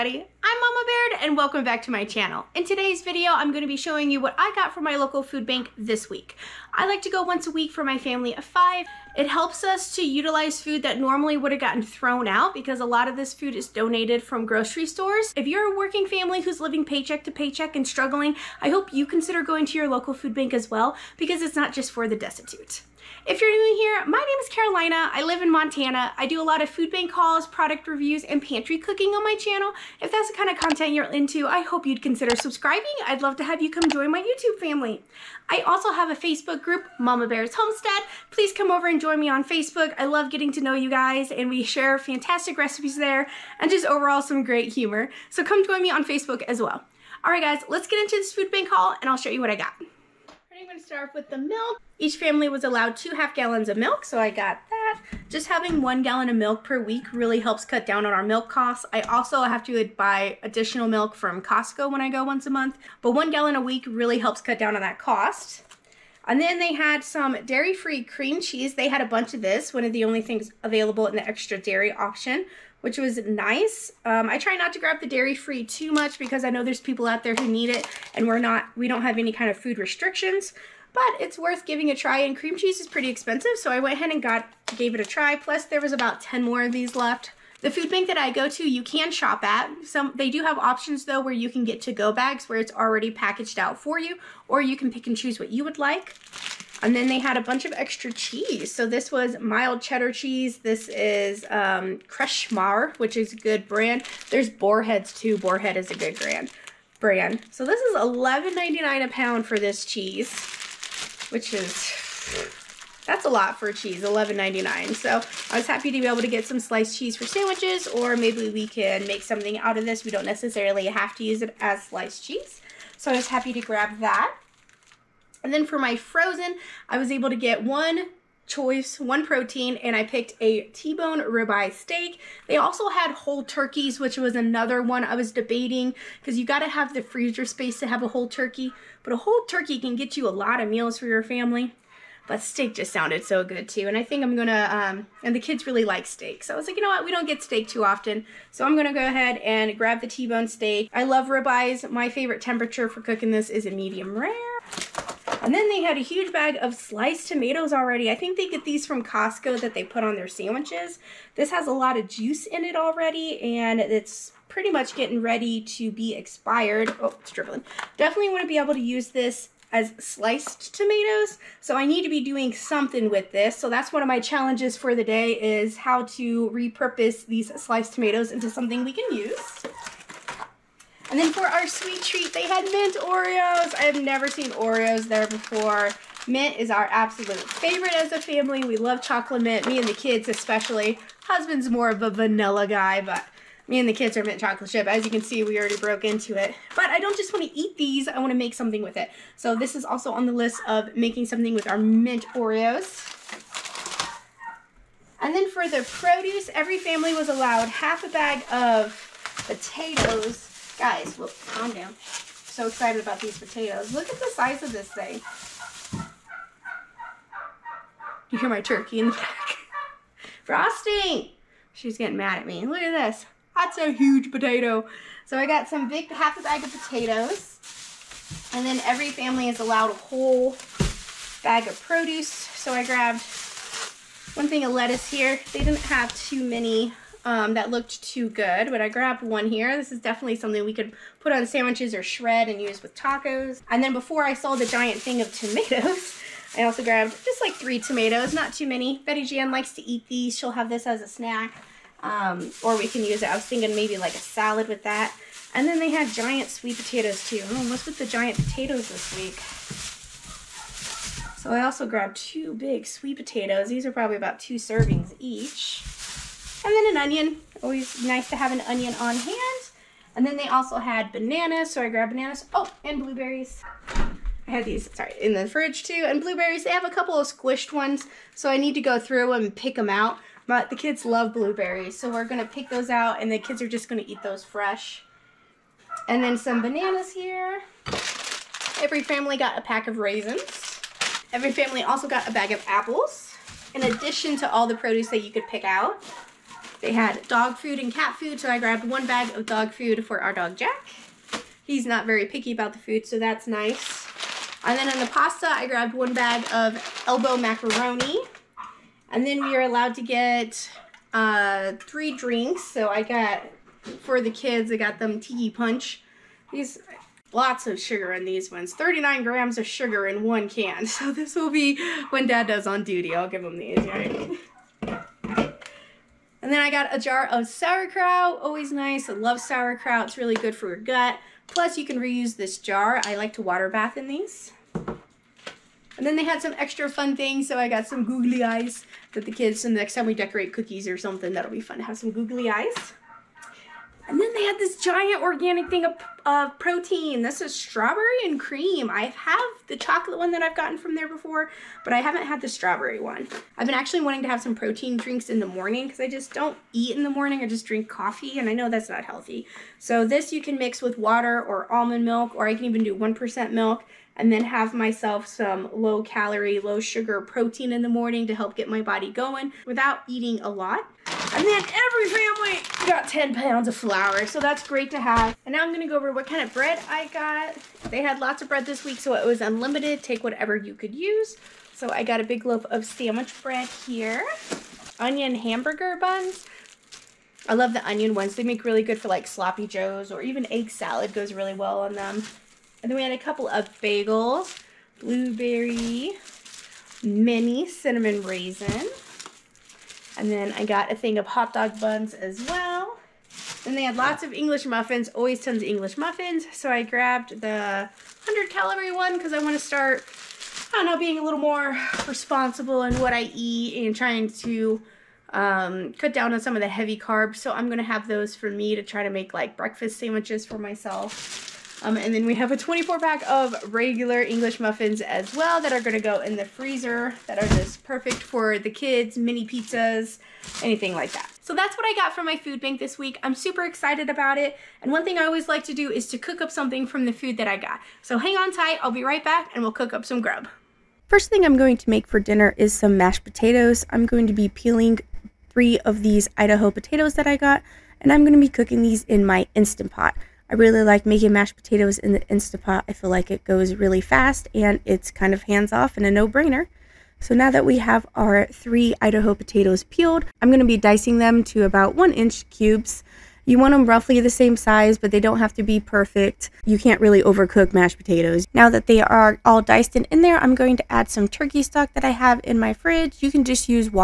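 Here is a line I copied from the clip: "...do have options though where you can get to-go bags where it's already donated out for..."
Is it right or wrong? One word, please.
wrong.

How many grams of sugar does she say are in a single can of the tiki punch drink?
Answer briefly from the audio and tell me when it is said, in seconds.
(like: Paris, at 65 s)
39, at 318 s.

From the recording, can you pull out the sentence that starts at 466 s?
You can't really overcook mashed potatoes.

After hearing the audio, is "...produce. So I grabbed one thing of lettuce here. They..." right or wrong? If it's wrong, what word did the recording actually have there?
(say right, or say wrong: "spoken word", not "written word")
right.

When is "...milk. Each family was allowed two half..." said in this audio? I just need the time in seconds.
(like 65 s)
51 s.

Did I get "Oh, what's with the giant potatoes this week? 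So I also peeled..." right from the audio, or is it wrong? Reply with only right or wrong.
wrong.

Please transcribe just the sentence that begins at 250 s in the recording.
She'll have this as a snack, um, or we can use it.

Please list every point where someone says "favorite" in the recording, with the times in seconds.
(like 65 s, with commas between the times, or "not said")
152 s, 187 s.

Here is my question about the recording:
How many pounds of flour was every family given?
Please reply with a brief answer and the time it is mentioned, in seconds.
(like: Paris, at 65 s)
10, at 373 s.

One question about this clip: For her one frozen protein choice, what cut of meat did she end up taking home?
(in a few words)
T-bone ribeye steak.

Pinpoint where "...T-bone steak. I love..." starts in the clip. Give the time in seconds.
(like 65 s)
150 s.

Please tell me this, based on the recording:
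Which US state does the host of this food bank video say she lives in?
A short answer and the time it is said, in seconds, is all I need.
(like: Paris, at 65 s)
Montana, at 25 s.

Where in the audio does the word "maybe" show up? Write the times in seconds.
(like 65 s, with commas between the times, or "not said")
118 s, 253 s.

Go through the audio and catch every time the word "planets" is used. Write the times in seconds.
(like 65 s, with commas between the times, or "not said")
not said.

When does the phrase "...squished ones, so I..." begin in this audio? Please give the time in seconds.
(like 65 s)
277 s.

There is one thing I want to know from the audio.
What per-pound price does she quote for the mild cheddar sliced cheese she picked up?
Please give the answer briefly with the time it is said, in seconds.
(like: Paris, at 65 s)
$11.99, at 107 s.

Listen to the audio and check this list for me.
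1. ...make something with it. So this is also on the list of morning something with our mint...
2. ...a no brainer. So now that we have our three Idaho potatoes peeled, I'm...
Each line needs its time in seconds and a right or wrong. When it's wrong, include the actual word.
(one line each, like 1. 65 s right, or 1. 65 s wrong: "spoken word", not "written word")
1. 198 s wrong: "making", not "morning"
2. 456 s right.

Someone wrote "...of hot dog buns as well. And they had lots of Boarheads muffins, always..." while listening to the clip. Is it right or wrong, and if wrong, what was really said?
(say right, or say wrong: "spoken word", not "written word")
wrong: "English", not "Boarheads".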